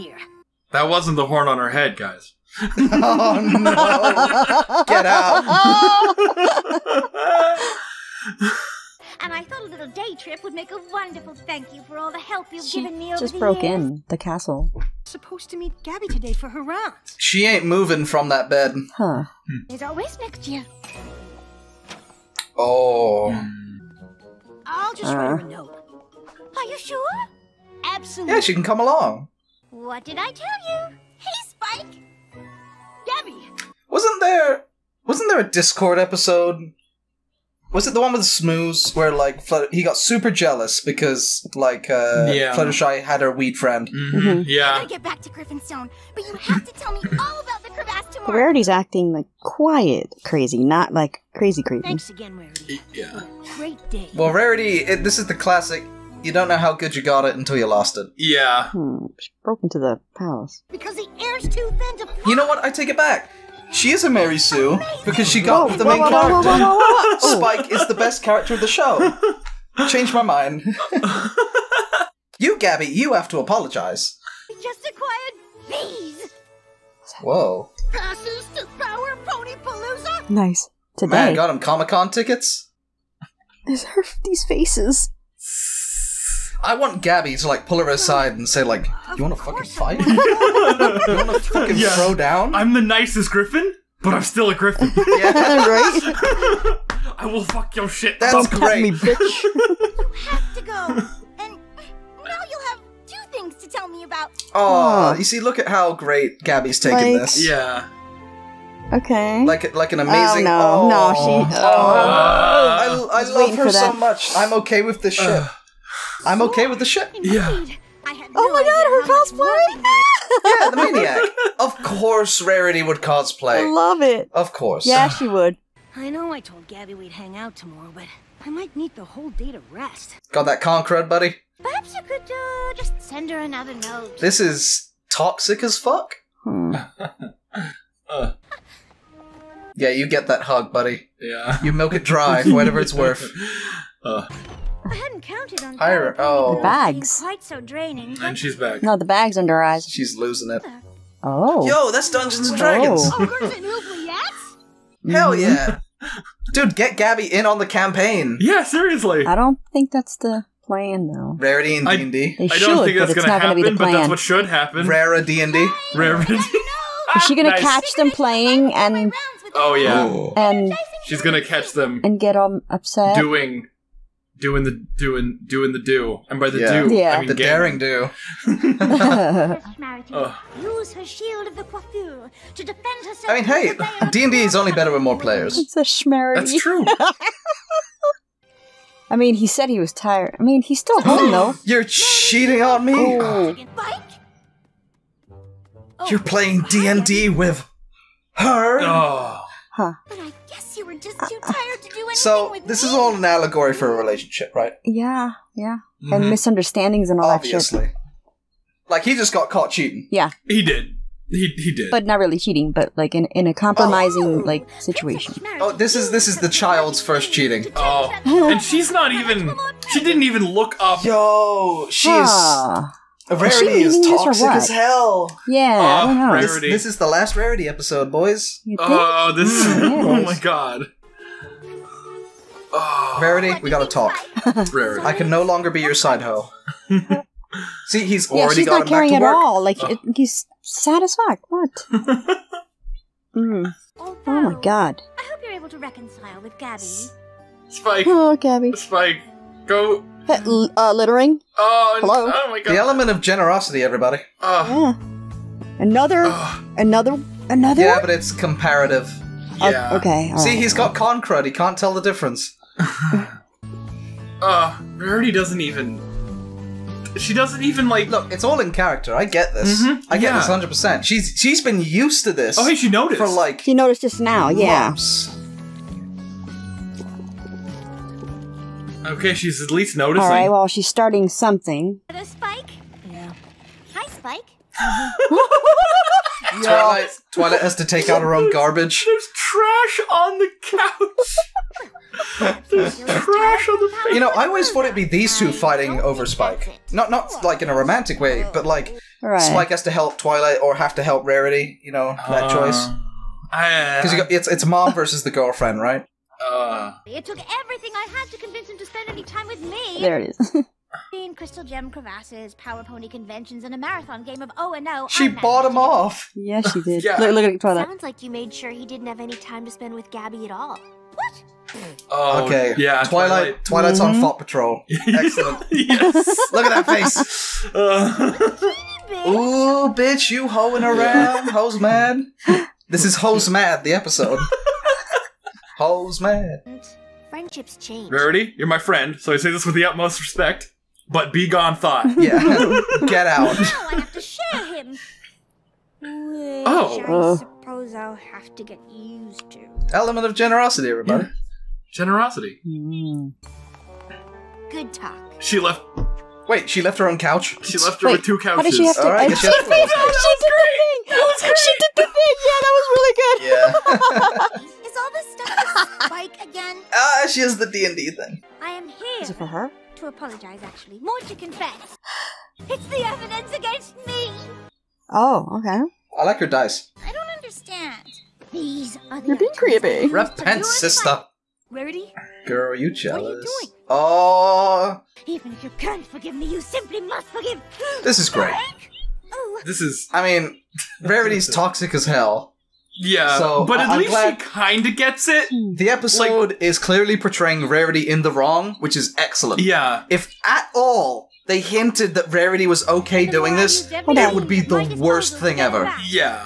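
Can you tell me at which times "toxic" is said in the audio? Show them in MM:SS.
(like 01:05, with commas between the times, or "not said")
02:15, 03:44, 06:31.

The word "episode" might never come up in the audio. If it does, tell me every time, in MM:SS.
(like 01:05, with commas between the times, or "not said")
00:35, 03:47, 05:33, 06:35.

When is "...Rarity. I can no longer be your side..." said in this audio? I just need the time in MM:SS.
03:54.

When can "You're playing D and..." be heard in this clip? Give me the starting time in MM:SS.
03:16.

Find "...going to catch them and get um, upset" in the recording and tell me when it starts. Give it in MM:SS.
02:51.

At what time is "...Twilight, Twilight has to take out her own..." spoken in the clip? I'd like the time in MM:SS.
04:46.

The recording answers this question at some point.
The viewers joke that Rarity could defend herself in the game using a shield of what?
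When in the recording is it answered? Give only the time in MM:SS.
03:01.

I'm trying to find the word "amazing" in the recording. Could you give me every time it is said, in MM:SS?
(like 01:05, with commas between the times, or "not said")
01:49.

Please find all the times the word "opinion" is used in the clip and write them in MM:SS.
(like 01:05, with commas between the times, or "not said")
not said.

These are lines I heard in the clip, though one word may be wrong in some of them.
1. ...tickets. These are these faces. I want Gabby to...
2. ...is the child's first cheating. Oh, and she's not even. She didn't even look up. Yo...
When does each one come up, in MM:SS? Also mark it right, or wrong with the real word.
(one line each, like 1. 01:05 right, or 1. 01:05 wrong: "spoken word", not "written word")
1. 01:22 right
2. 03:36 right.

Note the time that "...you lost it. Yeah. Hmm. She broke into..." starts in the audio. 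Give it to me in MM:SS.
00:57.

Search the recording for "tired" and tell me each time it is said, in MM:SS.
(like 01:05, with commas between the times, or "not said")
03:09, 03:21.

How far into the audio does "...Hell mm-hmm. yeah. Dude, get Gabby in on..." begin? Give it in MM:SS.
02:35.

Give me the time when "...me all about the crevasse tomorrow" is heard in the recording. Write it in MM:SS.
00:46.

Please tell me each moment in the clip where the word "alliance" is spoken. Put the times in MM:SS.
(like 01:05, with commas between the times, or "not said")
not said.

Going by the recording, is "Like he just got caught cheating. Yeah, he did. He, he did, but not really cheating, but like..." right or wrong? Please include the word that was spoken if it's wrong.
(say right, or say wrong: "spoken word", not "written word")
right.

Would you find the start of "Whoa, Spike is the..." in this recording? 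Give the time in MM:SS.
01:06.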